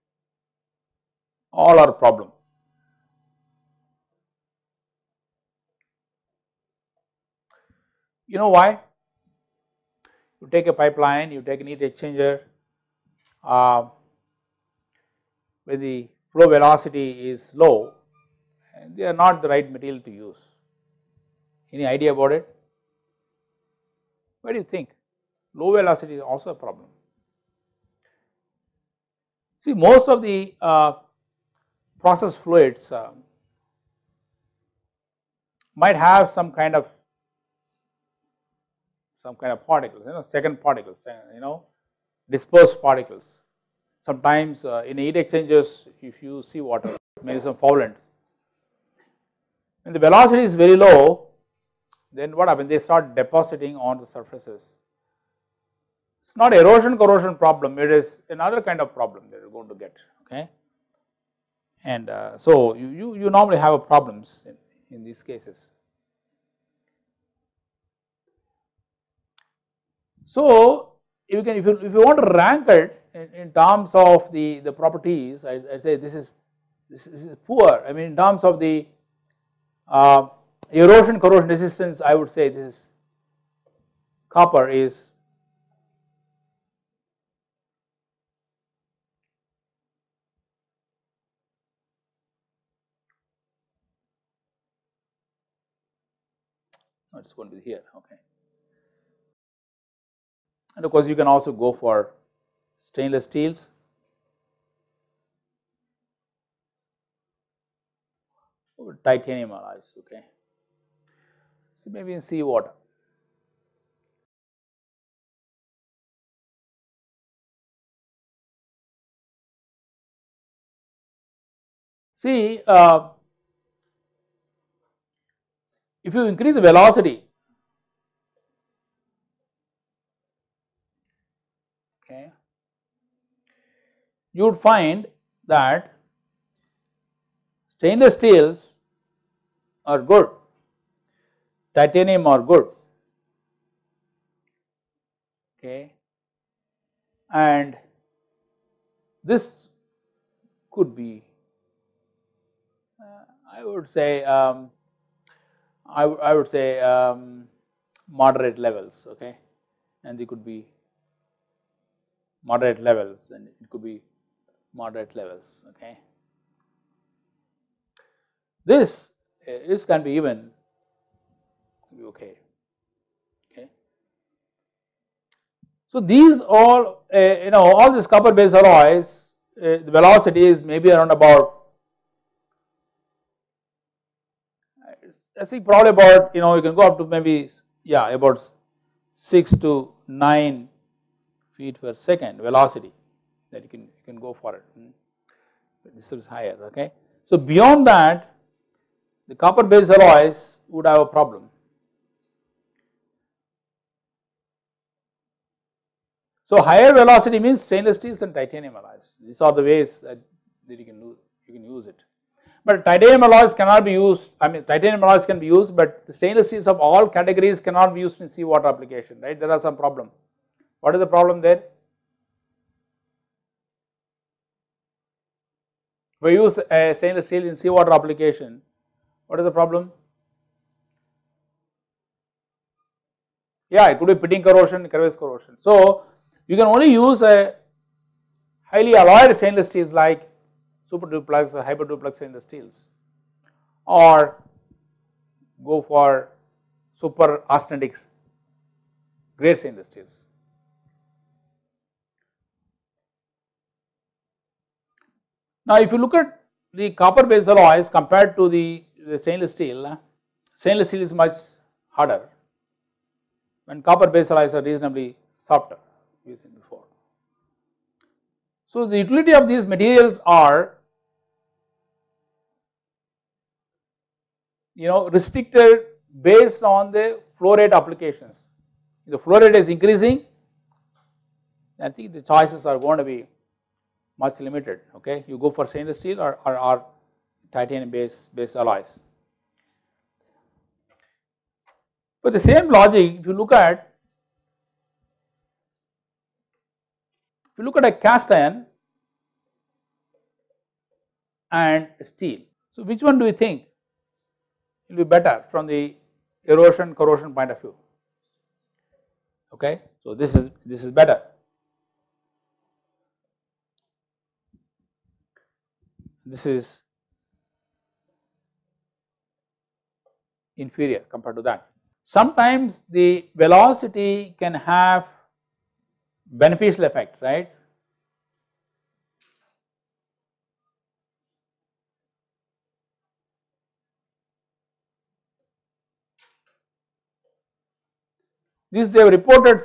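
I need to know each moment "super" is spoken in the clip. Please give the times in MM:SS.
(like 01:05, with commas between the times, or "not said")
04:00, 04:07.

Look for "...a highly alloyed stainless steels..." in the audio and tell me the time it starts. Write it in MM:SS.
03:57.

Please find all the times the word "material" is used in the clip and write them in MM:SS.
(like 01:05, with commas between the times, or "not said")
00:19, 04:29.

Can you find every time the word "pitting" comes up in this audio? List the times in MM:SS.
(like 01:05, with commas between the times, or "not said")
03:54.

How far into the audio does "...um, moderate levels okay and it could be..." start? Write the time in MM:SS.
02:36.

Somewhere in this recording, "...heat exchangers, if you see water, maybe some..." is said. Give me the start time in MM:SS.
00:44.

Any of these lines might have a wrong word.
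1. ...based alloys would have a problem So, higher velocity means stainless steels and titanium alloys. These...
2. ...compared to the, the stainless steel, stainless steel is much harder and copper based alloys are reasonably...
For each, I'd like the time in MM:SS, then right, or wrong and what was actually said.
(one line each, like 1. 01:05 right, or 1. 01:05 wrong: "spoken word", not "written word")
1. 03:19 right
2. 04:17 right.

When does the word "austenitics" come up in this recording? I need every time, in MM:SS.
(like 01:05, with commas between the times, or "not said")
04:07.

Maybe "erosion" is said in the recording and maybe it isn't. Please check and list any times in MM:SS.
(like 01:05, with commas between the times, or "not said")
00:56, 01:20, 05:06.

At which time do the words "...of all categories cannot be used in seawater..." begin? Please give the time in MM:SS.
03:36.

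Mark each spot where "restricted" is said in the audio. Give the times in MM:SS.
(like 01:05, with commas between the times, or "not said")
04:35.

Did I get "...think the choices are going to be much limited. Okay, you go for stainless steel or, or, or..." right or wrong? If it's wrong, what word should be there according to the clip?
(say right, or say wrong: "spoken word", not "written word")
right.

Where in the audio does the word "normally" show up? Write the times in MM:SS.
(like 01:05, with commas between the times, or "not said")
01:03.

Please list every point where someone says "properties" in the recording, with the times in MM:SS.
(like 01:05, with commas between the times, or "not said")
01:14.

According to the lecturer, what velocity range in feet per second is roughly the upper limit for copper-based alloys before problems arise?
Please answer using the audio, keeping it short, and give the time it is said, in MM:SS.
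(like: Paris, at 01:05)
6 to 9 feet per second, at 03:09.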